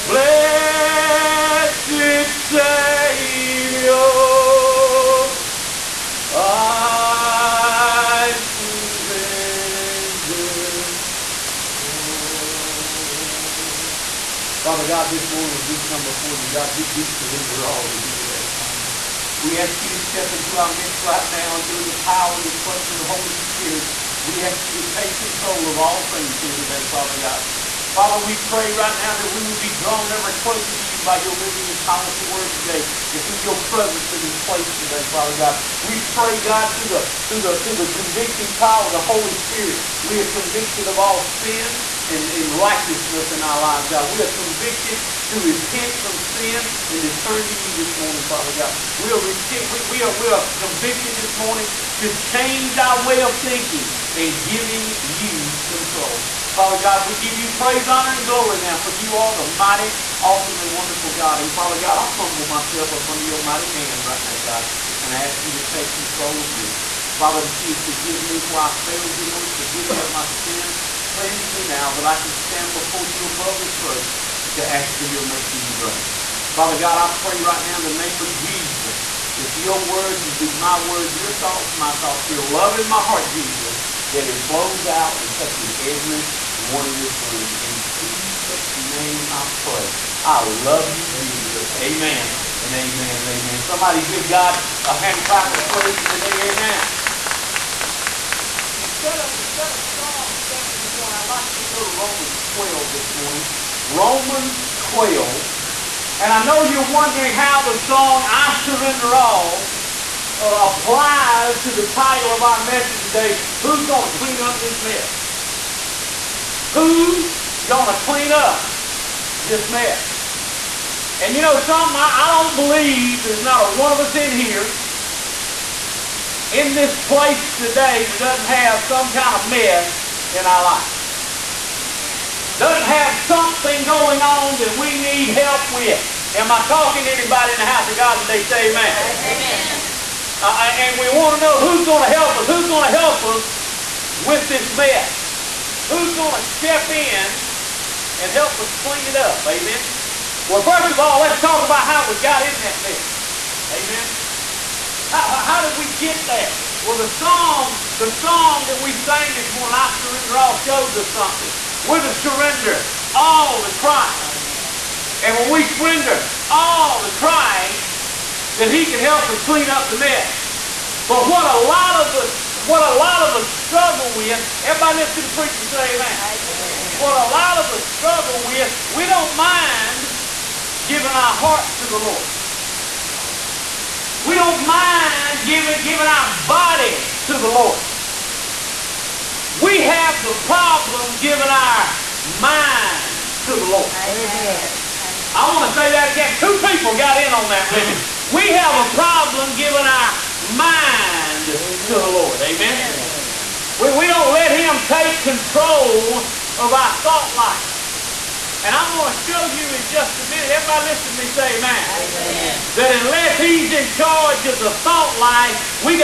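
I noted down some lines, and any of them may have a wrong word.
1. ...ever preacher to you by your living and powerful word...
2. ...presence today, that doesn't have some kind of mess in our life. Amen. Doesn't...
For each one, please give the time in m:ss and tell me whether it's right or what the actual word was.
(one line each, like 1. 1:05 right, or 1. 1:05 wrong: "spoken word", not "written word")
1. 0:30 wrong: "closer", not "preacher"
2. 2:07 wrong: "place", not "presence".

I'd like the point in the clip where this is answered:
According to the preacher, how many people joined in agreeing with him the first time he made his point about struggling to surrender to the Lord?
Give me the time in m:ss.
3:16.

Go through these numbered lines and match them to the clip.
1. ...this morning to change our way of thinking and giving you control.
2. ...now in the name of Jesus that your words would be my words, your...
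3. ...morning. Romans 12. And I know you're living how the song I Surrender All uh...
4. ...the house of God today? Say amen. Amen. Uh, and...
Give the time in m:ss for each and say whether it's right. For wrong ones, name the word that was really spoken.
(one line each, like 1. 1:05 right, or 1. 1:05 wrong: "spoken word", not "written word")
1. 0:51 right
2. 1:17 right
3. 1:43 wrong: "wondering", not "living"
4. 2:17 right.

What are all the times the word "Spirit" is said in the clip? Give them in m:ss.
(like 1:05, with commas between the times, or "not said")
0:23, 0:39.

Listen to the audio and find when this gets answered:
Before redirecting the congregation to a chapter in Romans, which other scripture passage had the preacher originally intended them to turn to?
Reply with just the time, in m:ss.
1:39.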